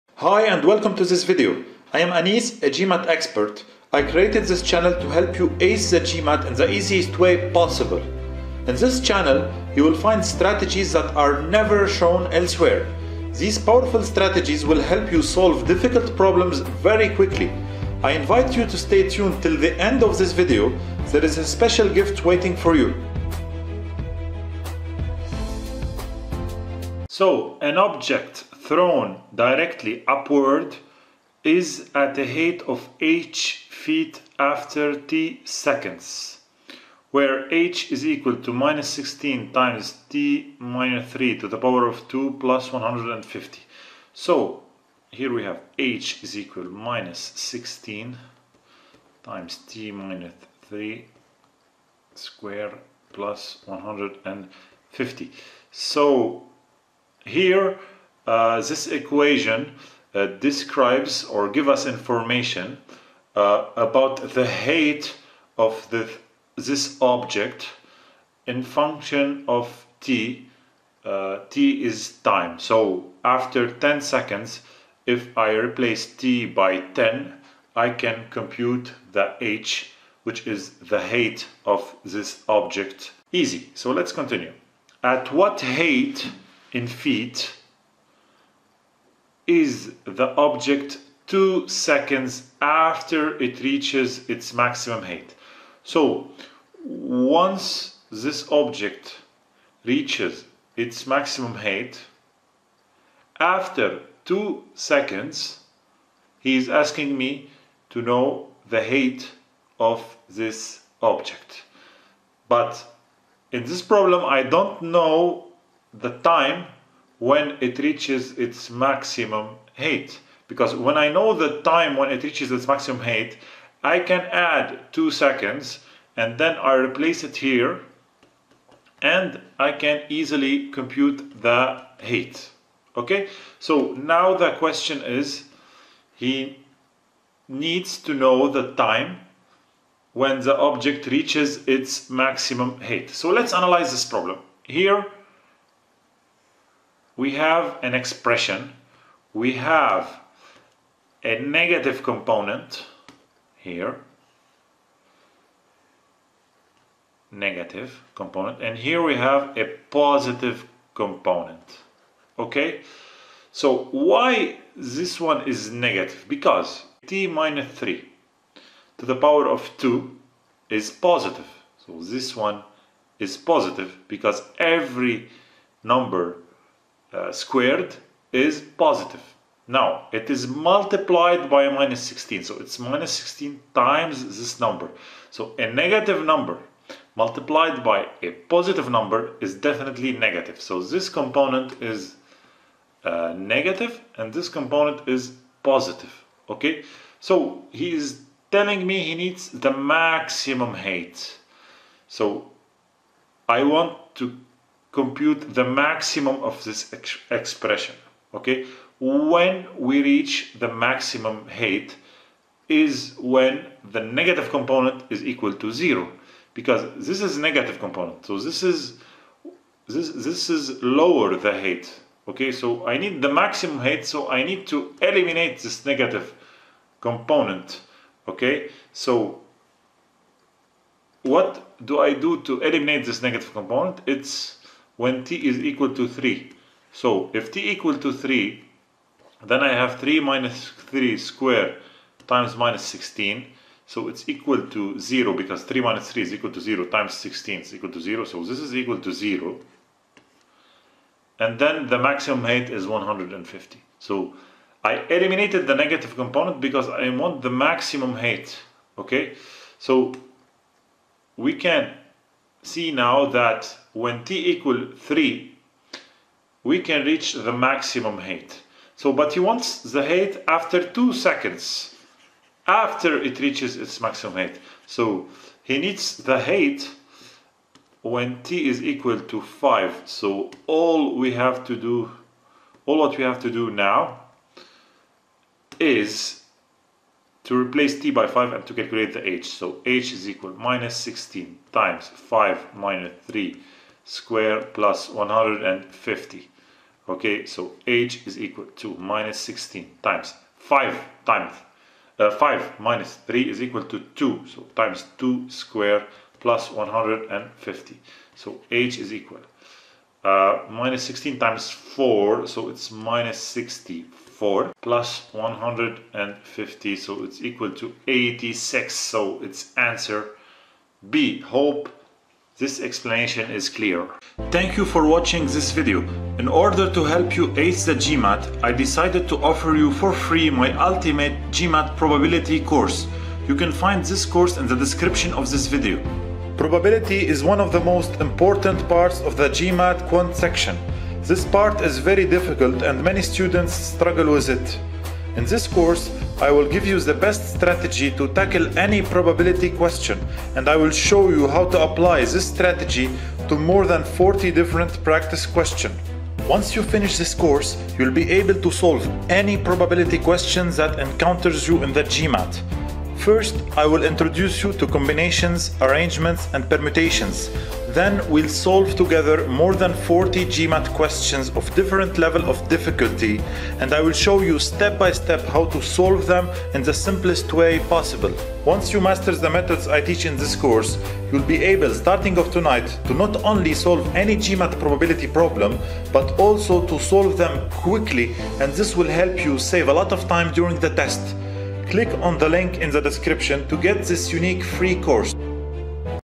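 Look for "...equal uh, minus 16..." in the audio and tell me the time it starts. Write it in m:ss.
5:09.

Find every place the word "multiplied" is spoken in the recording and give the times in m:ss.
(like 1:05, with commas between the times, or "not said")
3:00, 3:07.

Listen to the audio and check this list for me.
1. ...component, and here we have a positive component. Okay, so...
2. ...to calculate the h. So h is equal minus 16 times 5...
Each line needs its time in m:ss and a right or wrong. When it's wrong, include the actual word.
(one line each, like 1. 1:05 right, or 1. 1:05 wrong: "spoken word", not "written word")
1. 2:38 right
2. 4:48 right.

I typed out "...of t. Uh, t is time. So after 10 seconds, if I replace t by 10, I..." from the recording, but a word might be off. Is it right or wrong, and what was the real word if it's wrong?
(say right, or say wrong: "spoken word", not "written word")
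right.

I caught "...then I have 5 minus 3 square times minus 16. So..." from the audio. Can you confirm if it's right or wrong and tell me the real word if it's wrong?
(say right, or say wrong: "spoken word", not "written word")
wrong: "3", not "5".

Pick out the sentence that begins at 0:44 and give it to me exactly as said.
So here we have h is equal minus 16 times t minus 3 square plus 150.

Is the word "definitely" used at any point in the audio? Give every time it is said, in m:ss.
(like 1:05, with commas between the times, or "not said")
3:09.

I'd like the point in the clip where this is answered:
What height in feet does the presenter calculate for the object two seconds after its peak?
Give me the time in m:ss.
5:18.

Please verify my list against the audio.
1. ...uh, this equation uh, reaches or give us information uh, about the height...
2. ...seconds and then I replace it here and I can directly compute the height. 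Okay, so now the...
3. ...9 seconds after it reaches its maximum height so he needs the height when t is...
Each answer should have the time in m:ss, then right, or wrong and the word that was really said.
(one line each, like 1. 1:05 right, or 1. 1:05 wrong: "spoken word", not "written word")
1. 0:58 wrong: "describes", not "reaches"
2. 2:05 wrong: "easily", not "directly"
3. 4:30 wrong: "2", not "9".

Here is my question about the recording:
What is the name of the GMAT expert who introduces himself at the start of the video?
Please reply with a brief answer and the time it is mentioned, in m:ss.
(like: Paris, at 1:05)
Anis, at 0:02.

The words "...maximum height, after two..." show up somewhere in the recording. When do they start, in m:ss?
1:41.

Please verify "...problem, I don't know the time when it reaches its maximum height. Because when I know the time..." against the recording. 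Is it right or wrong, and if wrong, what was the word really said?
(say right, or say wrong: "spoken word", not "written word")
right.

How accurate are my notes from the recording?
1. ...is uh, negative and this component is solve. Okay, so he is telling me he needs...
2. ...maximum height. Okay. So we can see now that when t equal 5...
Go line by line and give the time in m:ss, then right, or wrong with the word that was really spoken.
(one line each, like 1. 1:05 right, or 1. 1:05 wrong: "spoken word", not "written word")
1. 3:11 wrong: "positive", not "solve"
2. 4:17 wrong: "3", not "5".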